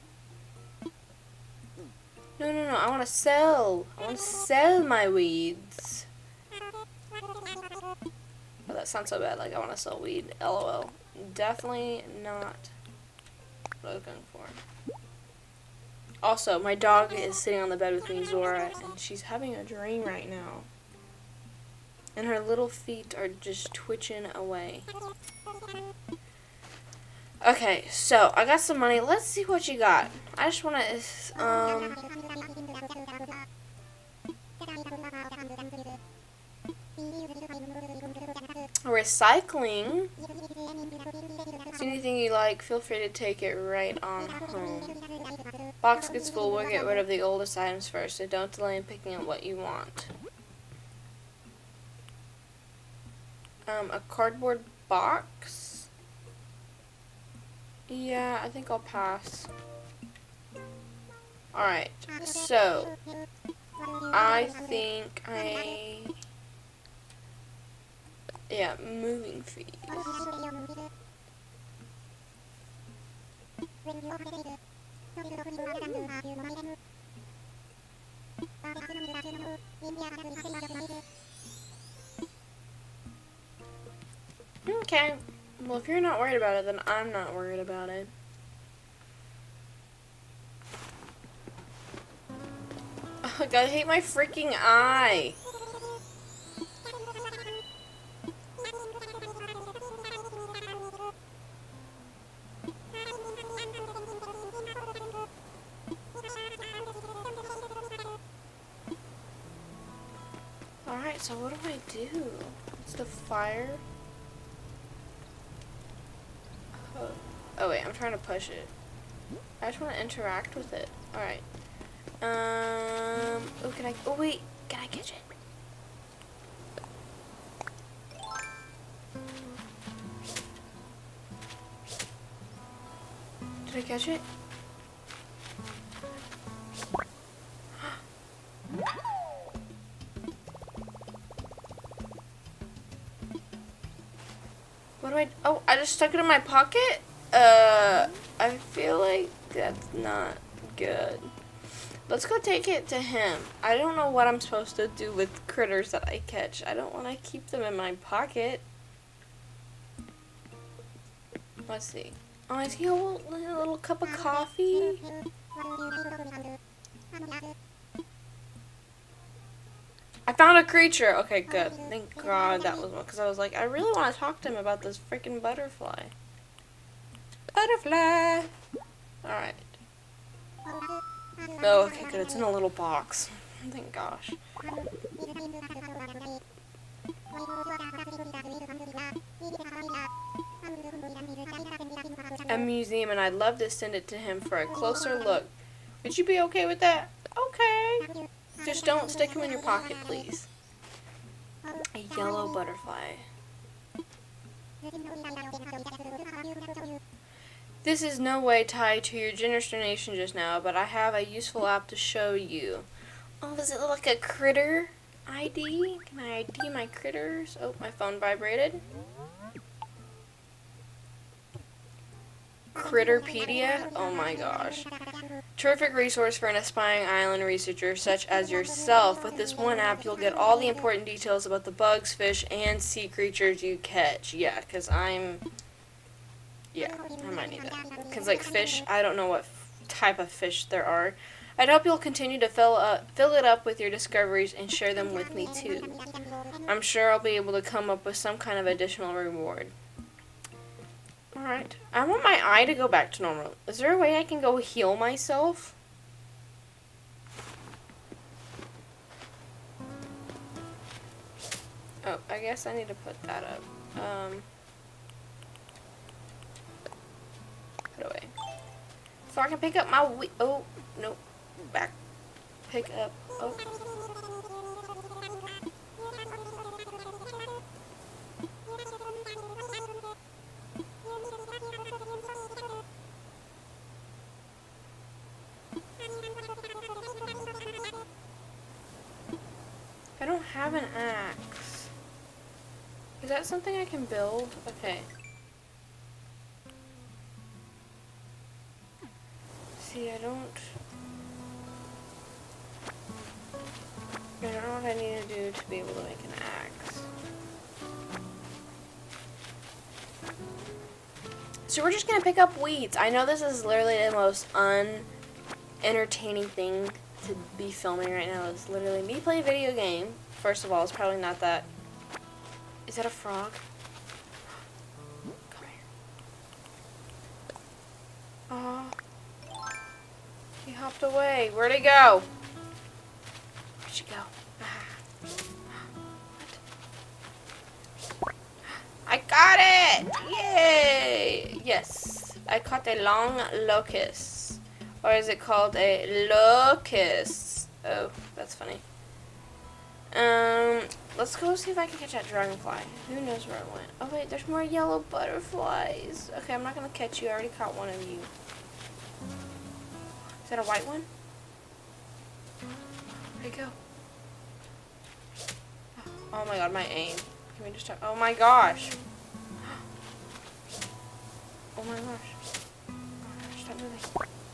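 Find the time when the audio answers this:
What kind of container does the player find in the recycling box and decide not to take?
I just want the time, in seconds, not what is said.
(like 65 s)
53 s.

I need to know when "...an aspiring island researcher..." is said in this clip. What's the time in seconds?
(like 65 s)
226 s.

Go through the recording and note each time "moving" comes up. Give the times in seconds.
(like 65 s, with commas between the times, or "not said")
68 s, 373 s.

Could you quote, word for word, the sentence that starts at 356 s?
Okay, I'm not gonna catch you.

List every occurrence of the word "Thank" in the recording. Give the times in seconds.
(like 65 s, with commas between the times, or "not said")
171 s, 183 s.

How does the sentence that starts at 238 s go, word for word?
Because, like, fish, I don't know what type of fish there are.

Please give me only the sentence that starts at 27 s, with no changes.
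Okay, so I got some money.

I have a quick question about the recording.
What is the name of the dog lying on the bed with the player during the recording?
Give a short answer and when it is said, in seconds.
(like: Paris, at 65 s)
Zora, at 18 s.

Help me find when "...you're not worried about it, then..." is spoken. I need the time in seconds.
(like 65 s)
85 s.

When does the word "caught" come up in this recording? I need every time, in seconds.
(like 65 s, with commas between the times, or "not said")
342 s, 357 s.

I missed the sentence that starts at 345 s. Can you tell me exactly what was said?
Or is it called a locust?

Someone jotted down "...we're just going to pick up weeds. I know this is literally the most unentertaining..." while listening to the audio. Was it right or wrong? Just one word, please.
right.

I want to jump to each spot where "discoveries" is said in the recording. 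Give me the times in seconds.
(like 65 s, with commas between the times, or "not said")
243 s.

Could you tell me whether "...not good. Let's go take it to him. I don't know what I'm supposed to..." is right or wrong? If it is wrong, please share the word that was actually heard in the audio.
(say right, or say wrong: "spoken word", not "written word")
right.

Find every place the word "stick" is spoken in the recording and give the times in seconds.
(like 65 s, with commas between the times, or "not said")
199 s.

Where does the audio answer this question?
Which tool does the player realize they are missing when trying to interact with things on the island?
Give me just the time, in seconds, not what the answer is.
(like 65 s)
290 s.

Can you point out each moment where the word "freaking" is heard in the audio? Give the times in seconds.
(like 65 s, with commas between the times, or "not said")
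93 s, 175 s.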